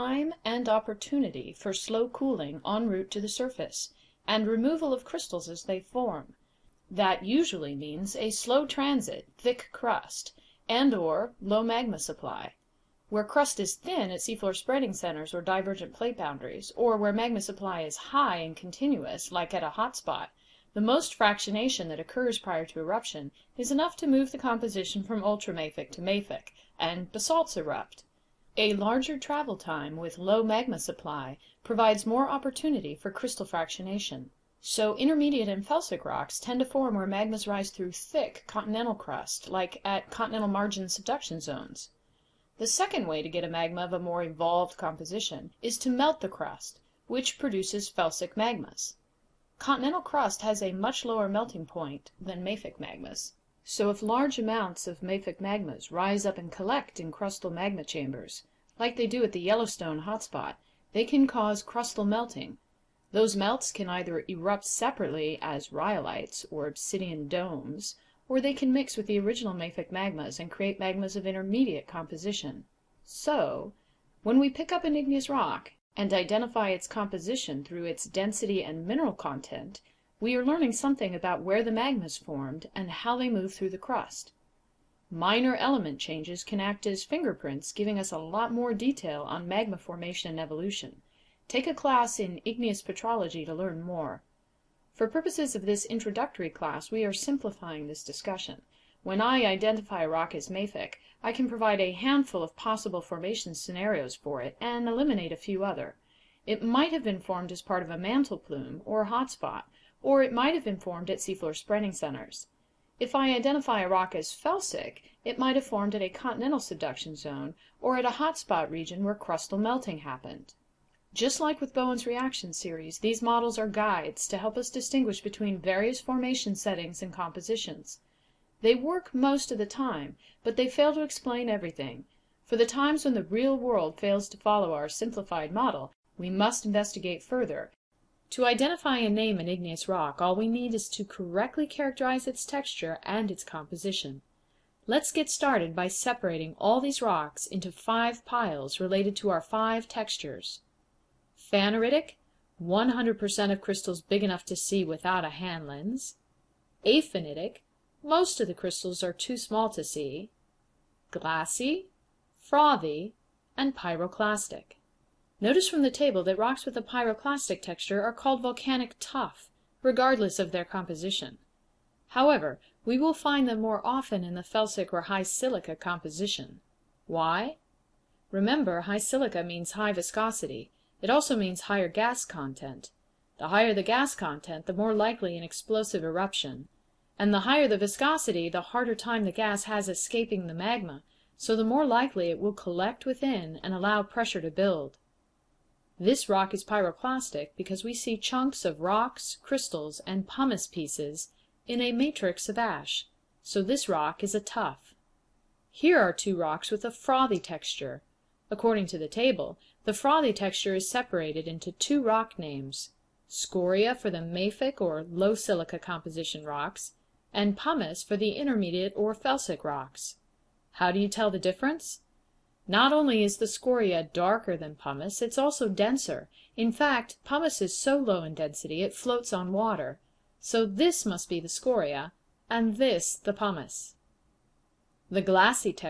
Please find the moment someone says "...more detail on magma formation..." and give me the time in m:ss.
1:28.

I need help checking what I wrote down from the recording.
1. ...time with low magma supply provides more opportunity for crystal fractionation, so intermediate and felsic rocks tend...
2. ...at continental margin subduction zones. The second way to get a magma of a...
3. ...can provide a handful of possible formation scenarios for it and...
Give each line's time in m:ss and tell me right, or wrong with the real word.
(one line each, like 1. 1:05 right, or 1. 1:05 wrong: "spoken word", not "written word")
1. 0:29 right
2. 0:39 right
3. 1:41 right.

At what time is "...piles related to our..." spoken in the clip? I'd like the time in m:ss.
2:28.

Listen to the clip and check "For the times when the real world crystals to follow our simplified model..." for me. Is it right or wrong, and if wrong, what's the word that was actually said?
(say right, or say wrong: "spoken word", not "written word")
wrong: "fails", not "crystals".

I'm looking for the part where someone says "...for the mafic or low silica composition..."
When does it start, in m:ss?
3:33.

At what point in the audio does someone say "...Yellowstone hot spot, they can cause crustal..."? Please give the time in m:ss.
0:59.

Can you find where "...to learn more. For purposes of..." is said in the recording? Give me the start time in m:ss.
1:33.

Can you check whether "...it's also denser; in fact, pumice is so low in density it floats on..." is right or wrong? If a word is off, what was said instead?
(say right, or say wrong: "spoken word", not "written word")
right.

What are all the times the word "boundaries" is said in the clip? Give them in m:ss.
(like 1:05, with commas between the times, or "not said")
0:16.